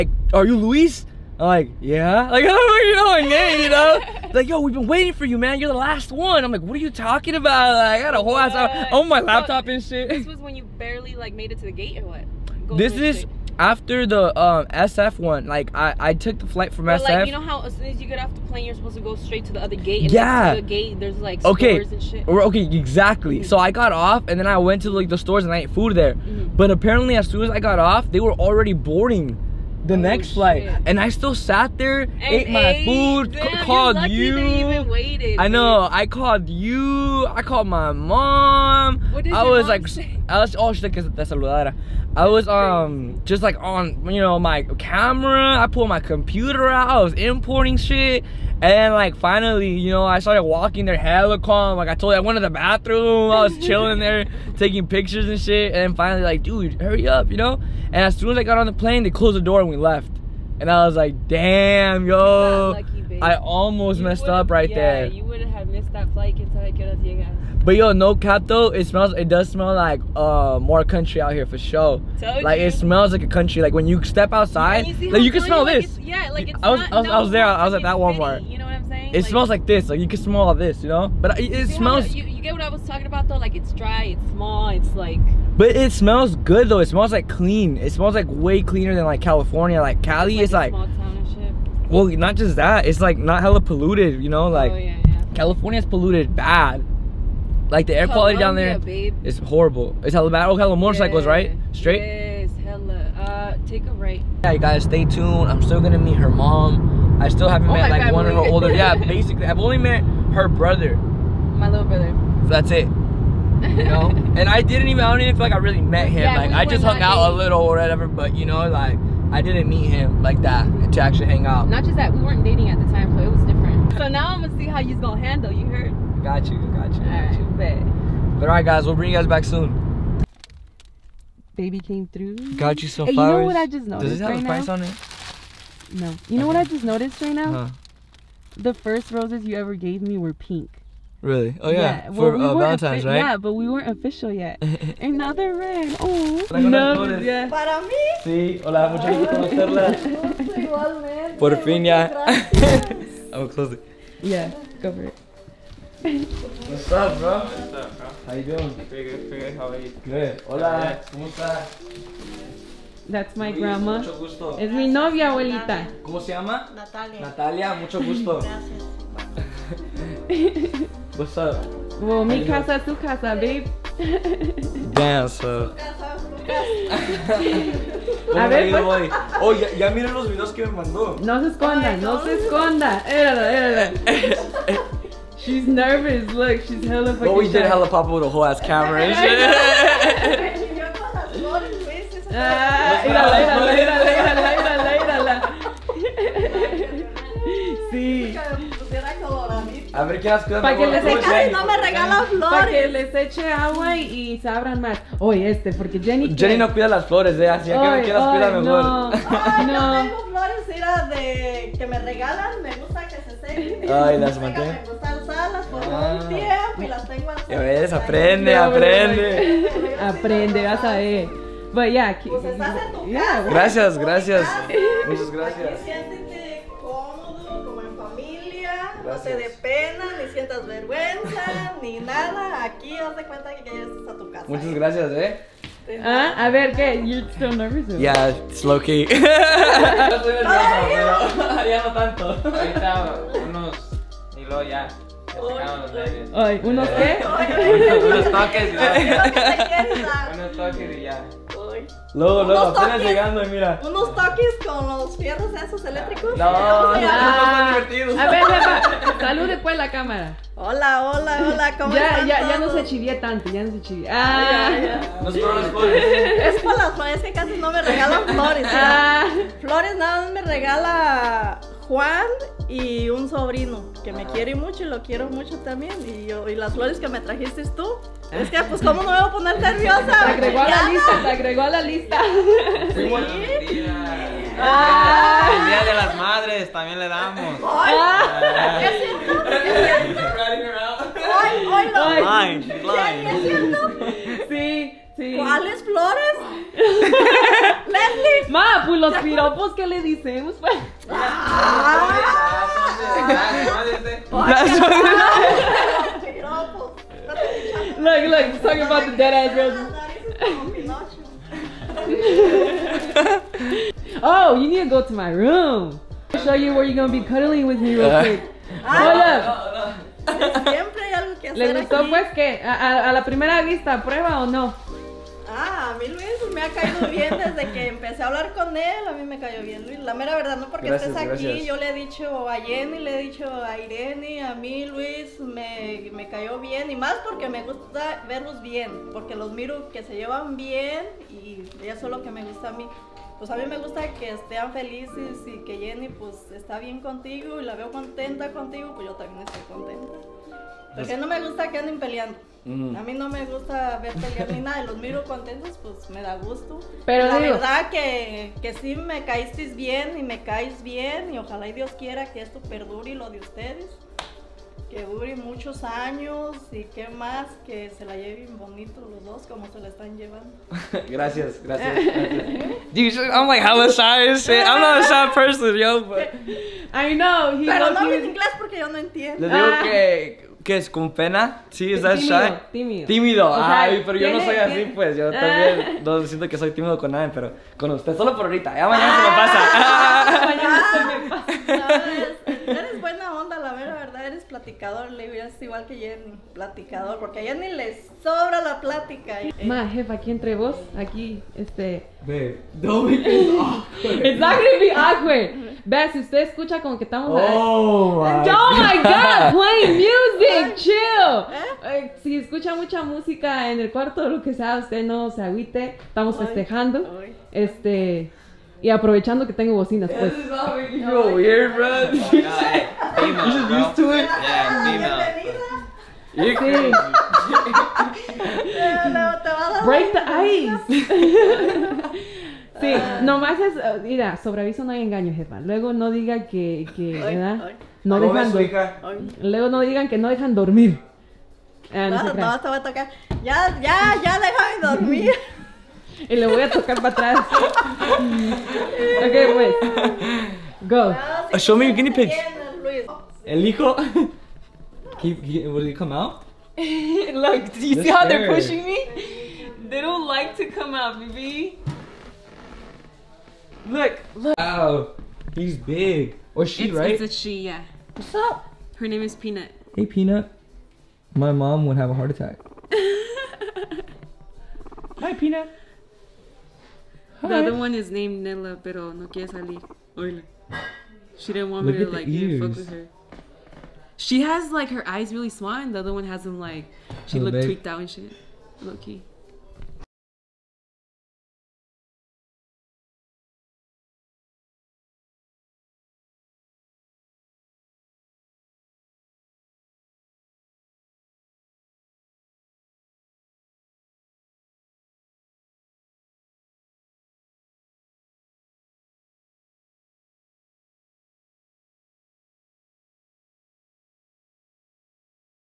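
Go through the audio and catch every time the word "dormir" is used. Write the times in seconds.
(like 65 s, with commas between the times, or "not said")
440 s, 444 s.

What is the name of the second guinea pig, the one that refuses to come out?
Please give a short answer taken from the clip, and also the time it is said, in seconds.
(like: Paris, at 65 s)
Nella, at 478 s.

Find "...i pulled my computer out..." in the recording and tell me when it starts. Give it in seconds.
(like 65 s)
45 s.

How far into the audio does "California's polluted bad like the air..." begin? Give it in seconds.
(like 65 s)
95 s.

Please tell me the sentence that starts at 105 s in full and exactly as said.
I'm still gonna meet her mom.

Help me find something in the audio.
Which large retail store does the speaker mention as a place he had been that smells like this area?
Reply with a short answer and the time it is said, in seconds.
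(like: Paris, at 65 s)
Walmart, at 77 s.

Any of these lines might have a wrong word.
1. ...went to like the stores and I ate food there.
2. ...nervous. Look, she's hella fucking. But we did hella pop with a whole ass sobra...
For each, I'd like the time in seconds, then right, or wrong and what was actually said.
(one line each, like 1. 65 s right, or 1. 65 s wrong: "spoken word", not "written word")
1. 24 s right
2. 185 s wrong: "camera", not "sobra".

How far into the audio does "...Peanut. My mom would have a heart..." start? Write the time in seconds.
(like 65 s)
470 s.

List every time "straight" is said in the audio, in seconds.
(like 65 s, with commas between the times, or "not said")
19 s, 101 s.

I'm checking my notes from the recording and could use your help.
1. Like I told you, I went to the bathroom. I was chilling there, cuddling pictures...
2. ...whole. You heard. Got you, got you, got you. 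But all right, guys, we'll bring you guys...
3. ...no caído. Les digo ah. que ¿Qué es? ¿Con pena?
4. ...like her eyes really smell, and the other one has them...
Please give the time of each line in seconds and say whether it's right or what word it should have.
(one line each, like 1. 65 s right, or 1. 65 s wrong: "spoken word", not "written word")
1. 51 s wrong: "taking", not "cuddling"
2. 125 s wrong: "handle", not "whole"
3. 378 s wrong: "entiendo", not "caído"
4. 484 s wrong: "small", not "smell".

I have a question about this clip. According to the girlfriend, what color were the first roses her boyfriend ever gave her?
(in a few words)
Pink.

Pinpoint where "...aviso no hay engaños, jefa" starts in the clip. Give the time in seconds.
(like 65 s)
434 s.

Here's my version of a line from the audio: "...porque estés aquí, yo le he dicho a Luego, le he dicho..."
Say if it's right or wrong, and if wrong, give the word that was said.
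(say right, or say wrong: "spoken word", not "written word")
wrong: "Jenny", not "Luego".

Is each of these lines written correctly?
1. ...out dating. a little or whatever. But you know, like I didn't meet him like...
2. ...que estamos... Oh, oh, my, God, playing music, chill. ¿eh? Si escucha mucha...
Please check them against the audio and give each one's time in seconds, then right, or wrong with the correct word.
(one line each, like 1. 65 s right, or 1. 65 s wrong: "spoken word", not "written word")
1. 117 s right
2. 406 s right.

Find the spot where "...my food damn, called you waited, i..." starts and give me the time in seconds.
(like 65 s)
32 s.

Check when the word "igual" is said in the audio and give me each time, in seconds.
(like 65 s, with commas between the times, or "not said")
395 s.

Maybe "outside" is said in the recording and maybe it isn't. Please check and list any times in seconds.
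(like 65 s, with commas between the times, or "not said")
74 s.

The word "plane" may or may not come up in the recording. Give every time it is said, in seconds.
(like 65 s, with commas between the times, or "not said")
18 s, 58 s.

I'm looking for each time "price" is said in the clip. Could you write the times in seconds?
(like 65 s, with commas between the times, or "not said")
134 s.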